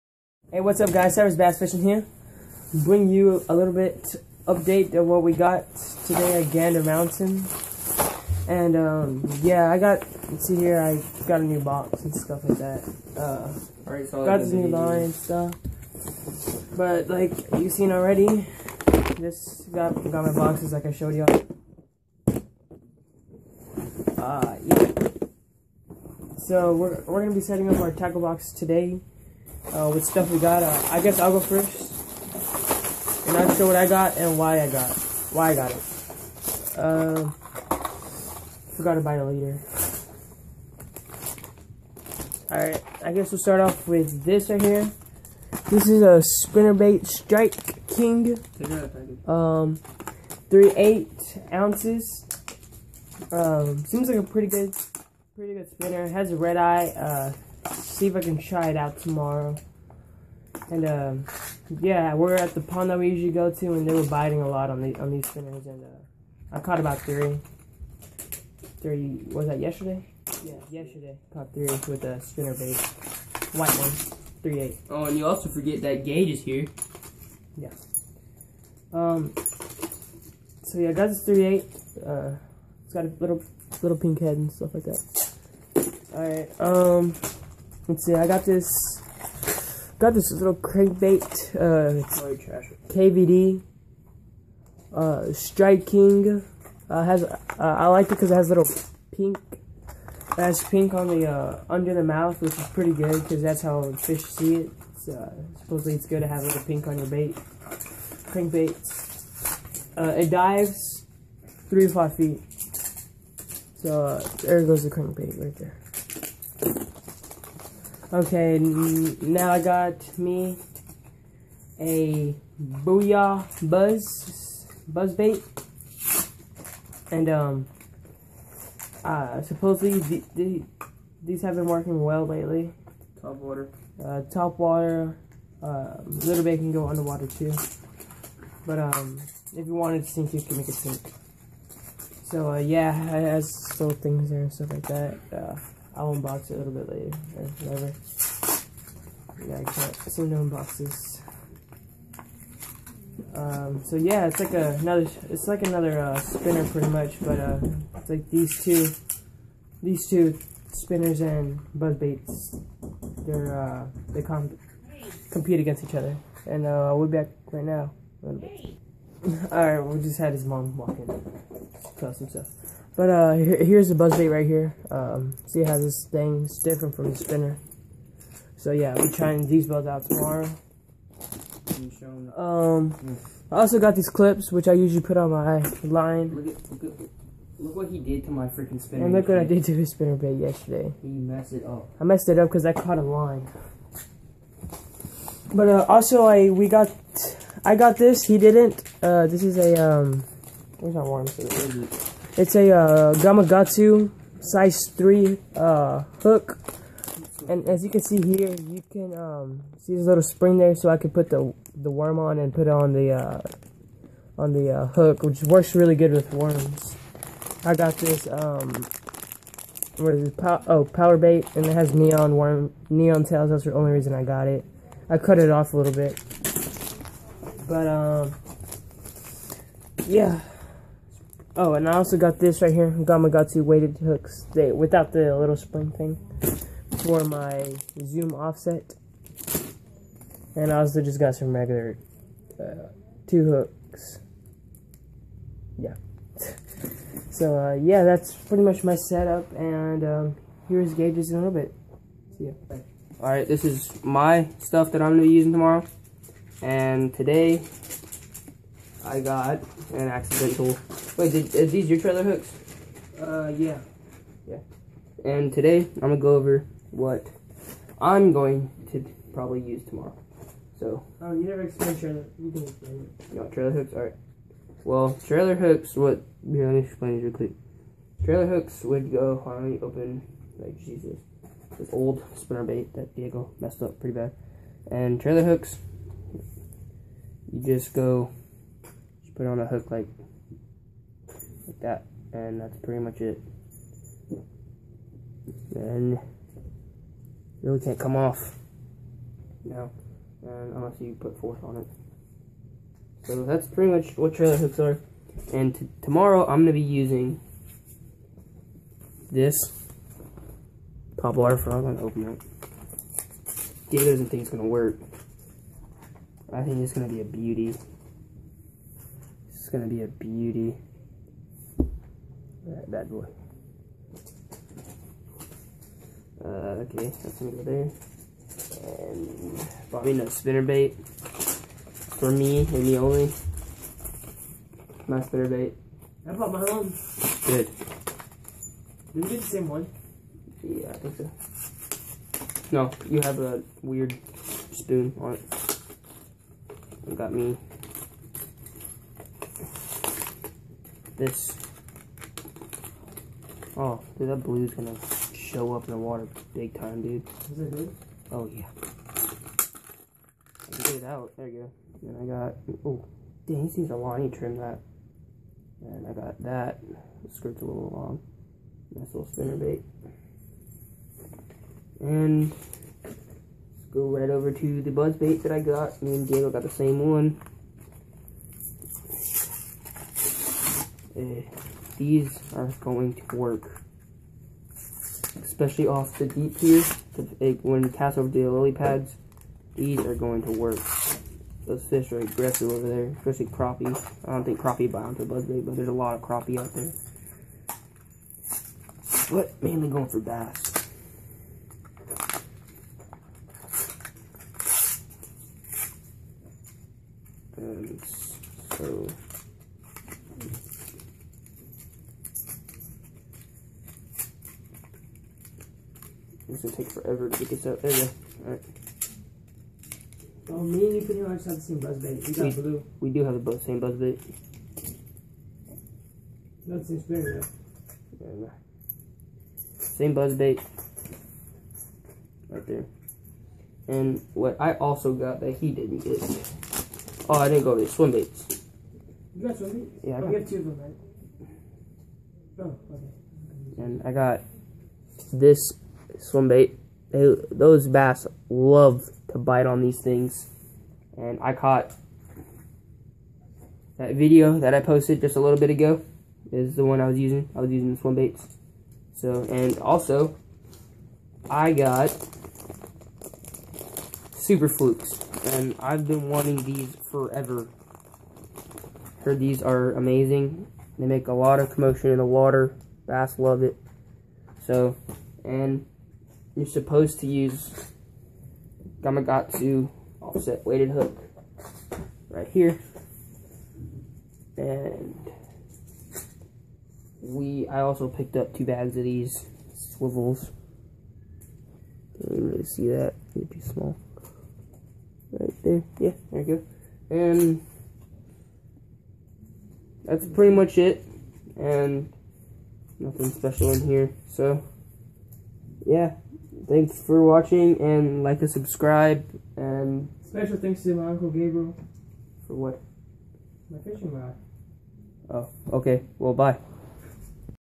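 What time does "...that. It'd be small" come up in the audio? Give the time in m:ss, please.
8:12.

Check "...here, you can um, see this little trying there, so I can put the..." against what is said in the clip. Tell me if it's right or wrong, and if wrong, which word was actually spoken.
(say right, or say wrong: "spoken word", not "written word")
wrong: "spring", not "trying".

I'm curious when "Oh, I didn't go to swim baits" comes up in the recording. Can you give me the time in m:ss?
7:17.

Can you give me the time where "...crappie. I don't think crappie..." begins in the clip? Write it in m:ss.
6:33.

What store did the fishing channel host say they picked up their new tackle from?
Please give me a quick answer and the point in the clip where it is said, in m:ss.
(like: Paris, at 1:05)
Gander Mountain, at 0:06.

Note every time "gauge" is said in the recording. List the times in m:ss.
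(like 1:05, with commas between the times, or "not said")
1:16, 4:10.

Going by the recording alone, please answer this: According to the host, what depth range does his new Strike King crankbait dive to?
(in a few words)
3 to 5 feet.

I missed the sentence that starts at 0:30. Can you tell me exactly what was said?
Uh, I guess I'll go first.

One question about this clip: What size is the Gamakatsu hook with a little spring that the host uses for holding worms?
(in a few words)
3.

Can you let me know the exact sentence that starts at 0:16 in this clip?
But, like, you've seen already, just got, got my boxes like I showed y'all.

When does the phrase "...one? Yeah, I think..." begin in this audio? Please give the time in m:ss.
5:39.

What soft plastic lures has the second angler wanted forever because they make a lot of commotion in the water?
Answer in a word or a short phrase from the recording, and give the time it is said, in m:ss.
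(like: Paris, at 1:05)
Super Flukes, at 7:44.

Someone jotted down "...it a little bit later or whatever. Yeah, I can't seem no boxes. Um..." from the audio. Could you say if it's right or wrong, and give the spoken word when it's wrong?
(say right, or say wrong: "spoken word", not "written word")
wrong: "unboxes", not "boxes".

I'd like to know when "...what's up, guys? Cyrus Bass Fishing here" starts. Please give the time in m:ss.
0:00.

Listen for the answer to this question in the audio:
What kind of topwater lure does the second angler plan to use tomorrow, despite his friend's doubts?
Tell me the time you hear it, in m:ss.
5:11.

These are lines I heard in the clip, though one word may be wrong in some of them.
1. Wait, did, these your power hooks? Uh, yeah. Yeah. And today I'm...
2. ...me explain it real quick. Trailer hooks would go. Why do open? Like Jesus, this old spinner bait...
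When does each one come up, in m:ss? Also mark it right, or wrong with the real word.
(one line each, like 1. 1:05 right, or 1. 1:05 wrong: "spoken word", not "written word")
1. 4:21 wrong: "trailer", not "power"
2. 4:36 right.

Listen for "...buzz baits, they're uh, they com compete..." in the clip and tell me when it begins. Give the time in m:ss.
2:41.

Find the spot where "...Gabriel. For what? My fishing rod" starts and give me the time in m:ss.
8:31.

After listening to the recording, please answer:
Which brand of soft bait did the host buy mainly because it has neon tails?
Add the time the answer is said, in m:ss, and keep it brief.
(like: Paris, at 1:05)
Power Bait, at 3:40.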